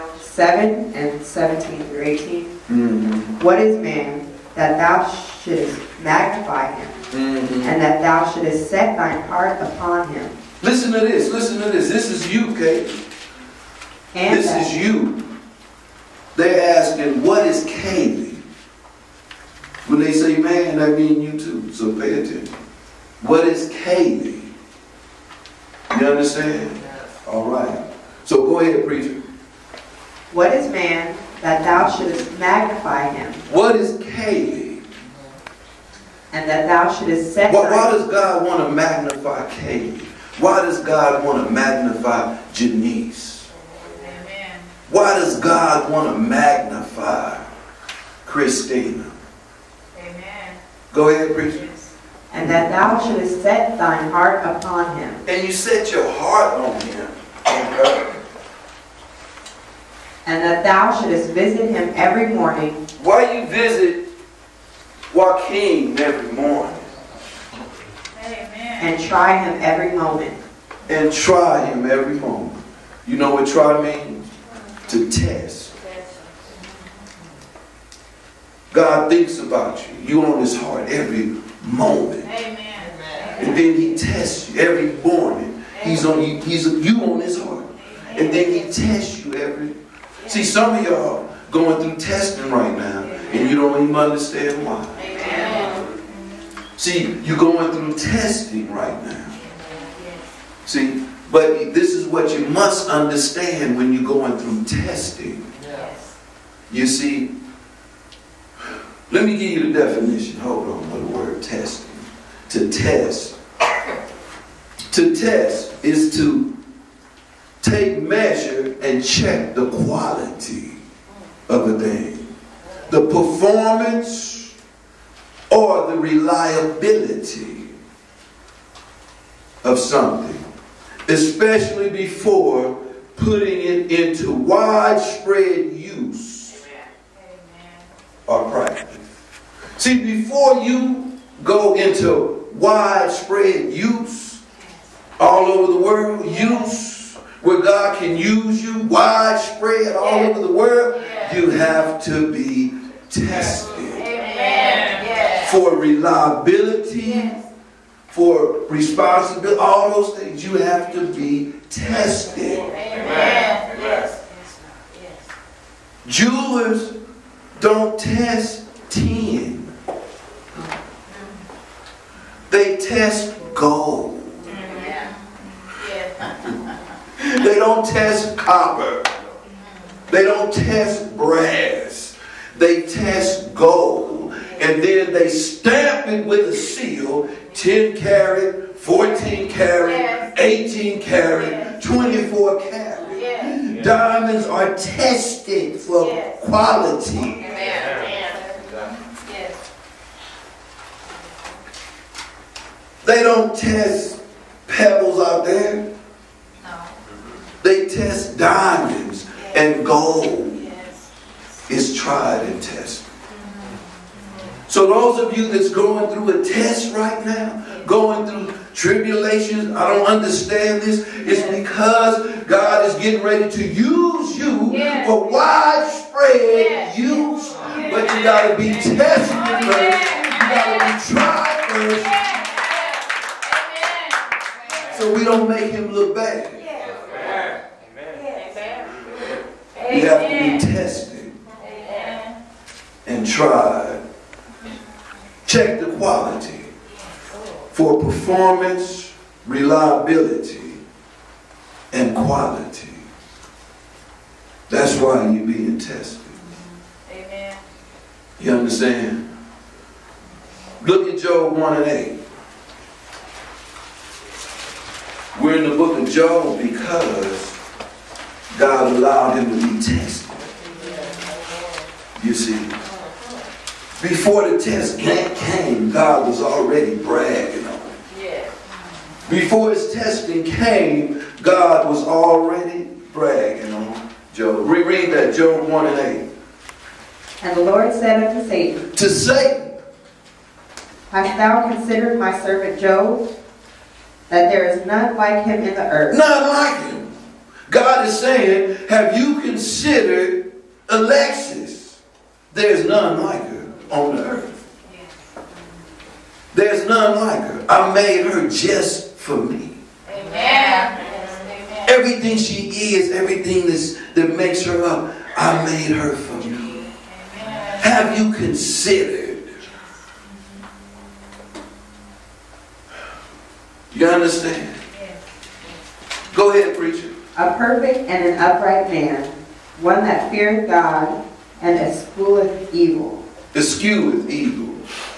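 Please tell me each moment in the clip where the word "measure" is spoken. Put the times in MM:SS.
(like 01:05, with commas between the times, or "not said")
01:58.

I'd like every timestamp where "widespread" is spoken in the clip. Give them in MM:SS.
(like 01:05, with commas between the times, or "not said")
02:14, 02:22, 02:28, 03:45.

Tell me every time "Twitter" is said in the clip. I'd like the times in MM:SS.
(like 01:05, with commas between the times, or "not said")
not said.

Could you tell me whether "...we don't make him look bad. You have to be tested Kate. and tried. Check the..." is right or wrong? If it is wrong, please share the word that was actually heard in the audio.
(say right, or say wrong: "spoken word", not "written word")
wrong: "Amen", not "Kate".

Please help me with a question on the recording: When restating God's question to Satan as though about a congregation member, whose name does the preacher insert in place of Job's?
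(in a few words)
Alexis.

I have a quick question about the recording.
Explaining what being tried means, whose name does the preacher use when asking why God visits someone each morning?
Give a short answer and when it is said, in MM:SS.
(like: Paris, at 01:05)
Joaquin, at 01:05.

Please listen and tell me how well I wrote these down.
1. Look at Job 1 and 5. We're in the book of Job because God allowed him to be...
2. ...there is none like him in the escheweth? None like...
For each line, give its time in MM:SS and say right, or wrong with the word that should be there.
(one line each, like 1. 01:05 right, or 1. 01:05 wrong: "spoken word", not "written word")
1. 04:20 wrong: "8", not "5"
2. 04:54 wrong: "earth", not "escheweth".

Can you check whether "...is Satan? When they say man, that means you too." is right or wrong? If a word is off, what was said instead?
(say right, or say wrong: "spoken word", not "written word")
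wrong: "Kaylee", not "Satan".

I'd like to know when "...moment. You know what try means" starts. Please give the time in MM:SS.
01:12.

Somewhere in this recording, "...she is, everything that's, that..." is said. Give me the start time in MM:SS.
05:12.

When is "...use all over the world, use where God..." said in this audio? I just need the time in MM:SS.
02:23.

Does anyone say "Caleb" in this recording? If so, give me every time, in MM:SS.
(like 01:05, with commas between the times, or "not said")
00:34, 00:39.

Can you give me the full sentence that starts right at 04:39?
Before his testing came, God was already bragging on Job.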